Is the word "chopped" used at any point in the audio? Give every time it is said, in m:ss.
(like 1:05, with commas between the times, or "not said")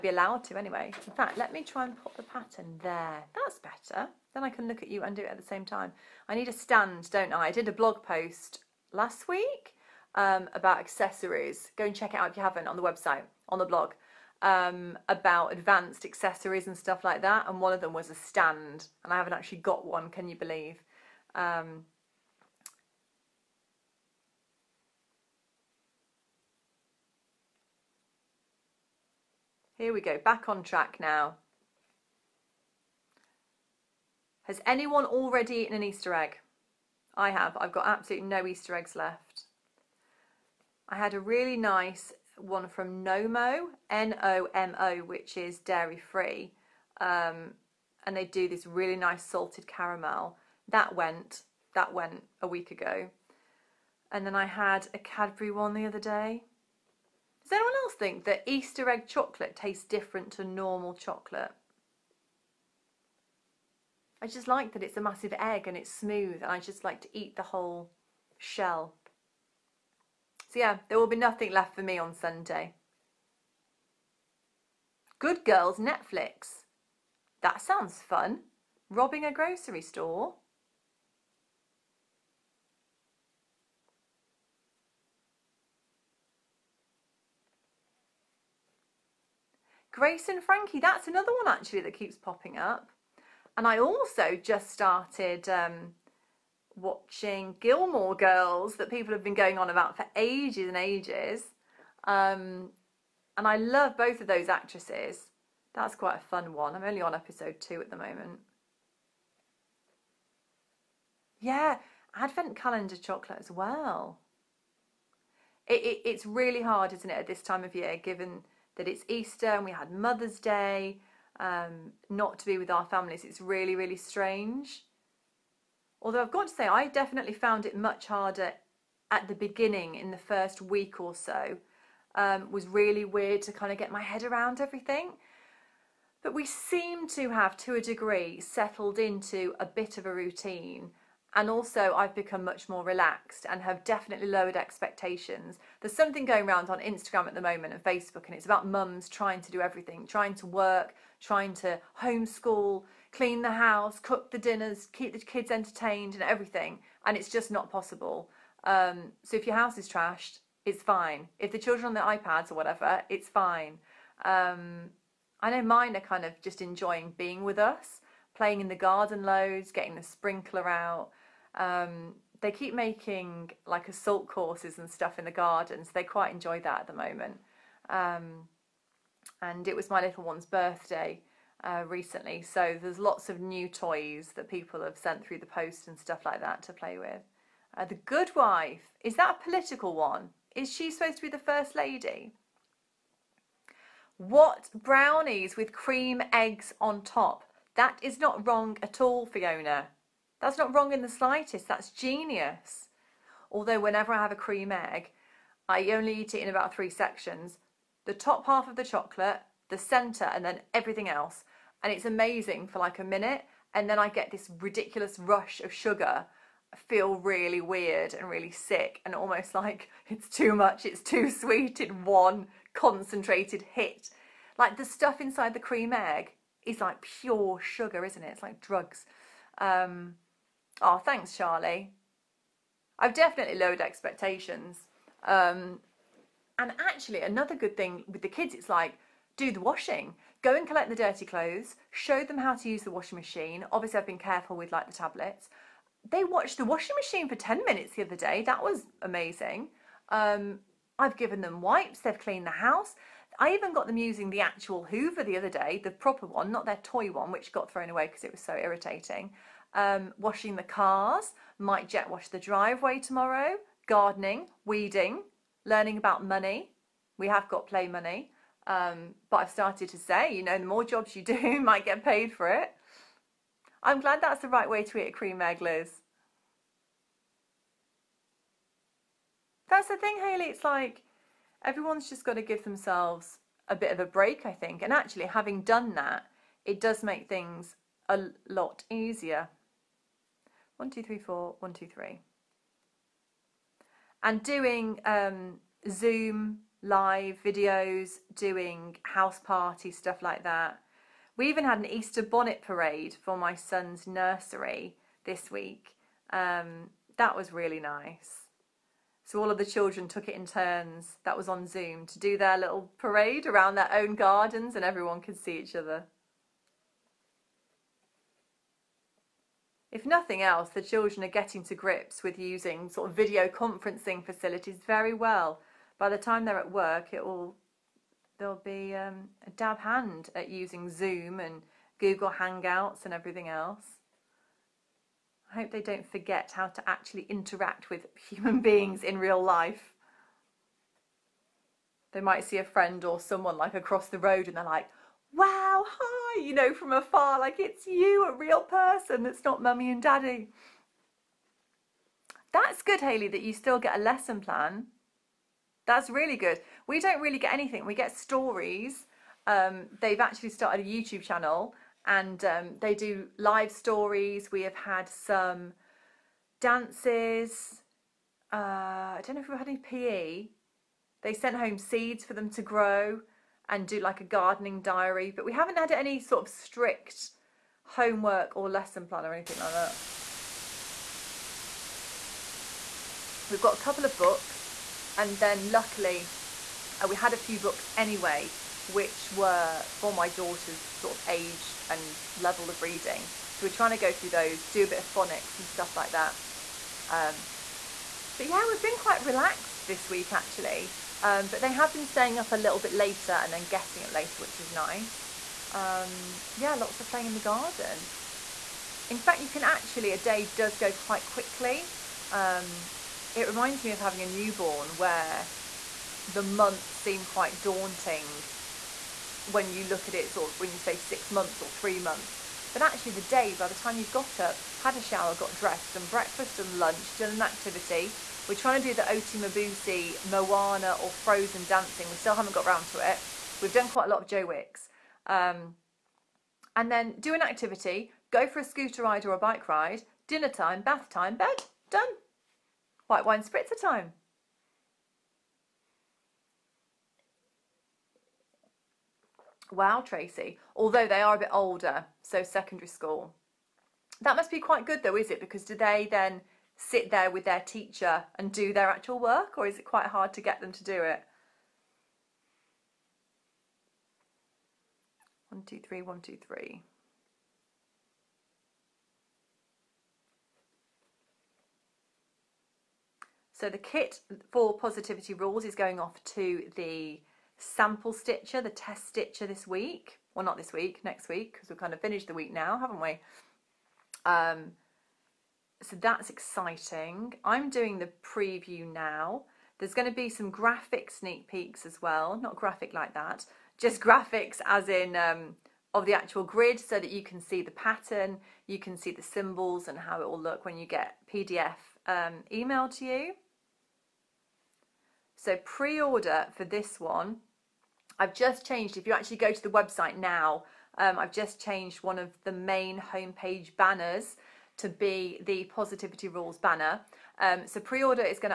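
not said.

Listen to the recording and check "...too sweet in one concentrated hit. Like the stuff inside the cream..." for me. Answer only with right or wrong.
right.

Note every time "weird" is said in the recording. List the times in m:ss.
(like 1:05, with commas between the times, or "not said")
2:13, 3:37.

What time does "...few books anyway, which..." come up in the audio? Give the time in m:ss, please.
6:27.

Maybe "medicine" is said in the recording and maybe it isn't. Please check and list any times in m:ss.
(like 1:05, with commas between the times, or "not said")
not said.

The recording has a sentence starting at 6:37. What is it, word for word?
Um, but yeah, we've been quite relaxed this week actually.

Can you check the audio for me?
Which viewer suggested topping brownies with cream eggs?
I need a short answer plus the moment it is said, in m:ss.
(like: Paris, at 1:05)
Fiona, at 3:19.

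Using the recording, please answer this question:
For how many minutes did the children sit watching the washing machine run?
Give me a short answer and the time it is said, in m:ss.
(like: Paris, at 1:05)
10, at 4:07.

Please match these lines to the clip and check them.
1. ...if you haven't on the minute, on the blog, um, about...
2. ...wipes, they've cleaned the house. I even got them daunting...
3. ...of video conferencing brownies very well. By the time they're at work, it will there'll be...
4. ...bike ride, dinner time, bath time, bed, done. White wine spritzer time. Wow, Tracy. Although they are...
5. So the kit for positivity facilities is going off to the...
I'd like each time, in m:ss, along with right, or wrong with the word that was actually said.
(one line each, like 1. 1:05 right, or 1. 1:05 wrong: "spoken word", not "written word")
1. 0:12 wrong: "website", not "minute"
2. 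4:11 wrong: "using", not "daunting"
3. 5:23 wrong: "facilities", not "brownies"
4. 7:19 right
5. 7:53 wrong: "rules", not "facilities".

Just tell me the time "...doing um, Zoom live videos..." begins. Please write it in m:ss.
4:54.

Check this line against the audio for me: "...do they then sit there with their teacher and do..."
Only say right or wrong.
right.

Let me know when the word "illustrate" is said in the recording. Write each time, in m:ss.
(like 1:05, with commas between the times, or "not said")
not said.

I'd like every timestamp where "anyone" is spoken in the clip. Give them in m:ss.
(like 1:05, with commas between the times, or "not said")
0:34, 0:57.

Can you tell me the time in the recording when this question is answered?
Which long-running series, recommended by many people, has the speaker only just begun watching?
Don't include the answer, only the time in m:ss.
1:37.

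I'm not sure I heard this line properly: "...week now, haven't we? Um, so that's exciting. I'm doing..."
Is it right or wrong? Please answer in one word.
right.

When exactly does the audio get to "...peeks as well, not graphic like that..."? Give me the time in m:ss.
8:11.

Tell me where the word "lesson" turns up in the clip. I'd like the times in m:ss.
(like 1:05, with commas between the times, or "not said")
5:54, 6:18.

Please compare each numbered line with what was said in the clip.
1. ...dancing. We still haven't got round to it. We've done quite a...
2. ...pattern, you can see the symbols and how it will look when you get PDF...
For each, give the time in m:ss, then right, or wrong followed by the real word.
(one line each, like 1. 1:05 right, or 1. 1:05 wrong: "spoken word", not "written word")
1. 7:11 right
2. 8:17 right.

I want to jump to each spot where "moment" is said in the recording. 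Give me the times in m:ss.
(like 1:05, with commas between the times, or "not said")
1:47, 2:27, 2:56.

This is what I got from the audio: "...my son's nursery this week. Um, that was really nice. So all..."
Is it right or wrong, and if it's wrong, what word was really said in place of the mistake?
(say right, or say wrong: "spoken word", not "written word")
right.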